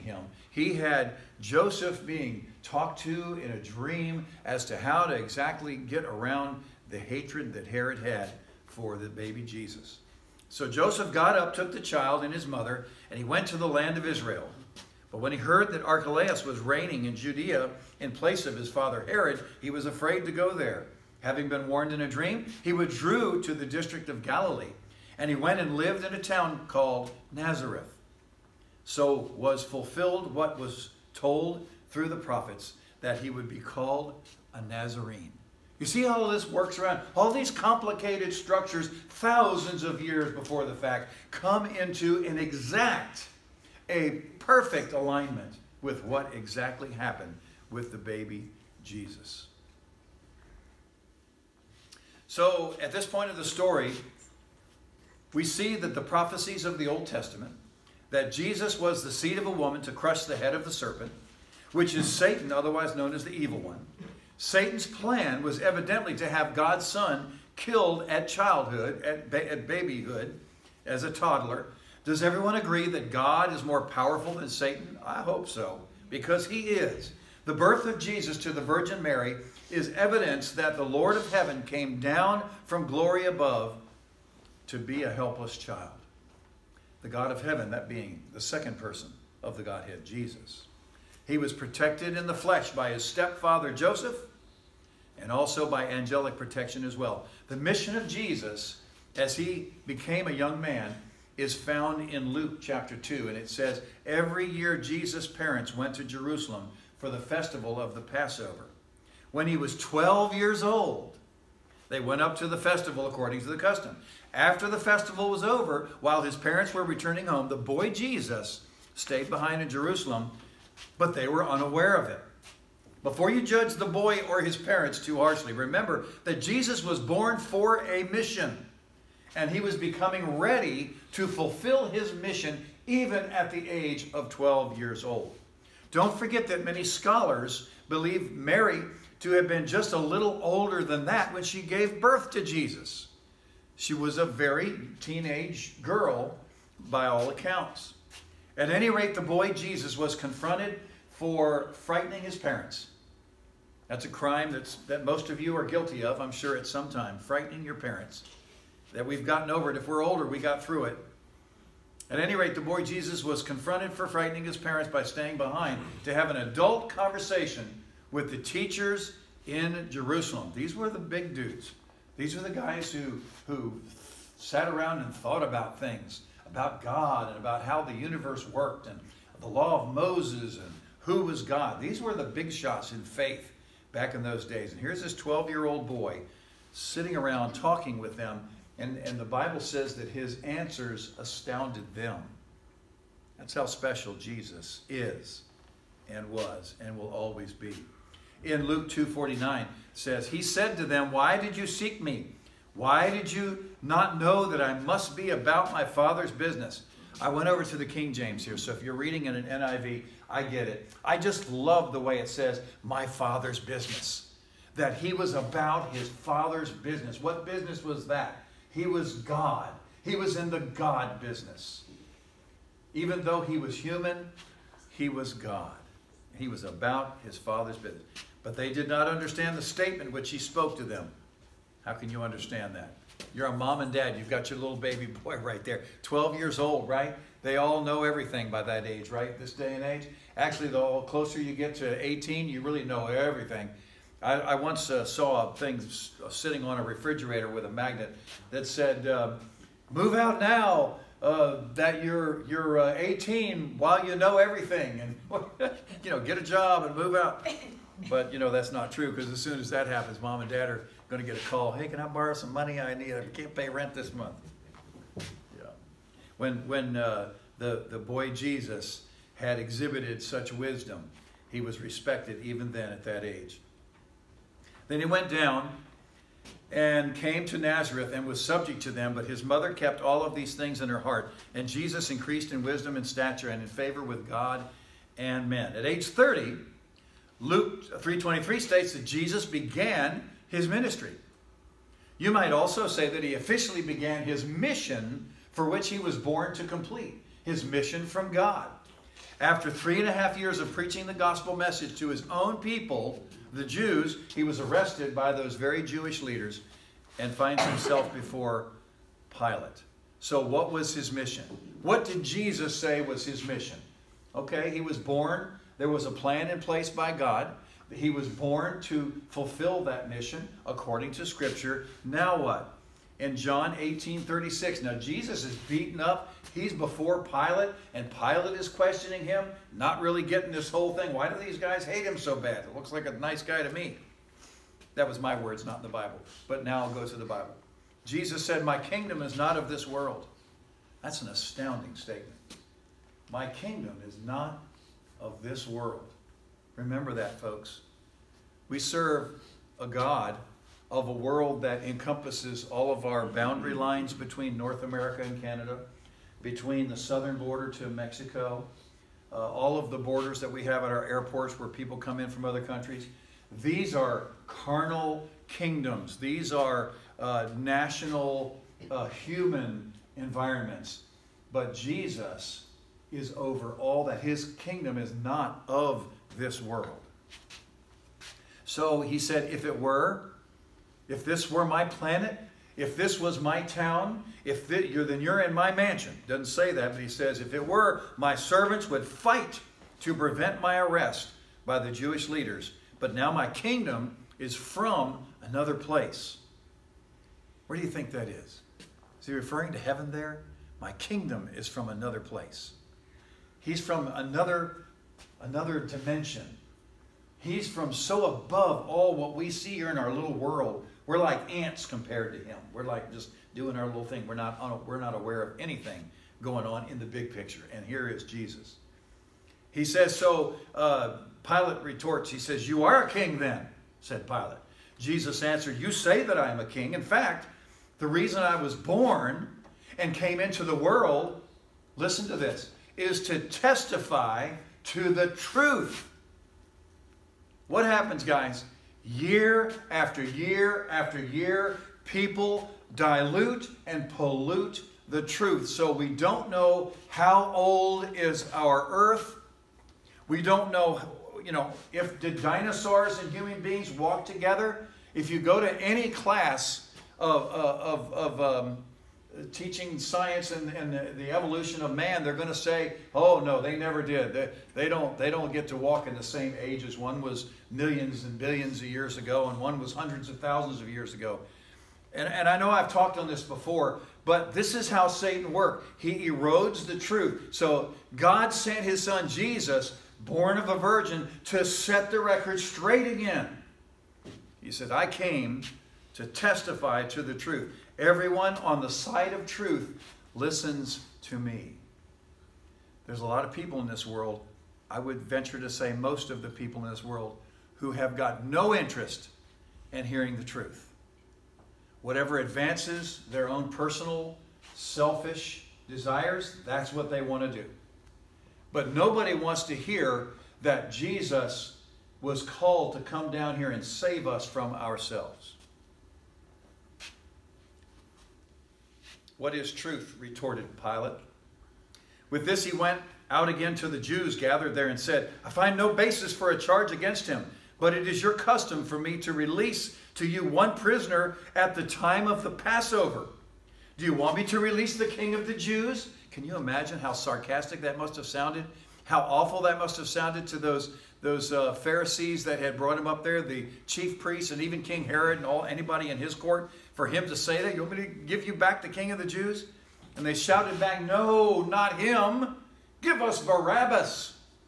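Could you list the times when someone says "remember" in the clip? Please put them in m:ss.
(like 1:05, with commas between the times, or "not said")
2:05, 5:46.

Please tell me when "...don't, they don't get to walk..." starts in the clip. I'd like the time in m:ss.
7:44.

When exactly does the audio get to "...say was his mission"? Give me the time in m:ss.
5:12.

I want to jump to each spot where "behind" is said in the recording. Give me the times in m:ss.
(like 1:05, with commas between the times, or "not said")
1:59, 2:45.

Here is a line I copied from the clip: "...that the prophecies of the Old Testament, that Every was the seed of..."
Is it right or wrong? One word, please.
wrong.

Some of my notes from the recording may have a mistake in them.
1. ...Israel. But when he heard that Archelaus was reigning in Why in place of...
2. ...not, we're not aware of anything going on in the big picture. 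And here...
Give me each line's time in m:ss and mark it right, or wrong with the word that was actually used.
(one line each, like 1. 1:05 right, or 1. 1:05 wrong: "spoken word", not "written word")
1. 0:14 wrong: "Judea", not "Why"
2. 6:54 right.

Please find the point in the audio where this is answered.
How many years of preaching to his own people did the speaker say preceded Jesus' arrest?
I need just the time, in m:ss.
4:59.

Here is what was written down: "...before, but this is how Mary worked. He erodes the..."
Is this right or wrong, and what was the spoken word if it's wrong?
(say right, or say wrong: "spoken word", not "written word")
wrong: "Satan", not "Mary".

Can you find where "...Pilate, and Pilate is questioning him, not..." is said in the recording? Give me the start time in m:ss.
5:27.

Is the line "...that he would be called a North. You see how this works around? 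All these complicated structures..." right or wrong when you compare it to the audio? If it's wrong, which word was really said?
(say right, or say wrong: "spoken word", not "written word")
wrong: "Nazarene", not "North".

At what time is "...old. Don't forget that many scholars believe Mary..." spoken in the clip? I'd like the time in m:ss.
2:15.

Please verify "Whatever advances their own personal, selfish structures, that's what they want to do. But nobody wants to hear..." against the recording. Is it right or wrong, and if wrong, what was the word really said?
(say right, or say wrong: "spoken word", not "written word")
wrong: "desires", not "structures".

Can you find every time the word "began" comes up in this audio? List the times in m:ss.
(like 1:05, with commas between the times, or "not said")
4:49, 4:53.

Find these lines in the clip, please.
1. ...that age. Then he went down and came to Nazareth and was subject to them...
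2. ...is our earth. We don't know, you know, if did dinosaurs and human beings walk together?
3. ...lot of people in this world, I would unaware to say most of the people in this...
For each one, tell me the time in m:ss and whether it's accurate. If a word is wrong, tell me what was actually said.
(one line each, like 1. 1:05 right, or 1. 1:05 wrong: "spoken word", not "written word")
1. 4:33 right
2. 7:28 right
3. 8:13 wrong: "venture", not "unaware".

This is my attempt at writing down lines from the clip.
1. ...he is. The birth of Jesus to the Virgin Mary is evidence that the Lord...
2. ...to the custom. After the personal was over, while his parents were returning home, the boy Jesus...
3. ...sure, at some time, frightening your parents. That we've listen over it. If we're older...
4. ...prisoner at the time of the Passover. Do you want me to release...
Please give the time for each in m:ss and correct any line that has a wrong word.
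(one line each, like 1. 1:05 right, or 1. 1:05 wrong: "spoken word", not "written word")
1. 1:16 right
2. 1:53 wrong: "festival", not "personal"
3. 2:36 wrong: "gotten", not "listen"
4. 8:50 right.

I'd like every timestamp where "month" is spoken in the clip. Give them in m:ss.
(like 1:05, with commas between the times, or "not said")
4:24.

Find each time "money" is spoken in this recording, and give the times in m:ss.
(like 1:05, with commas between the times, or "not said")
4:22.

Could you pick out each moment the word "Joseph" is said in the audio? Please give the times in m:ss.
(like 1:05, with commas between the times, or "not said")
0:01, 0:10, 1:33.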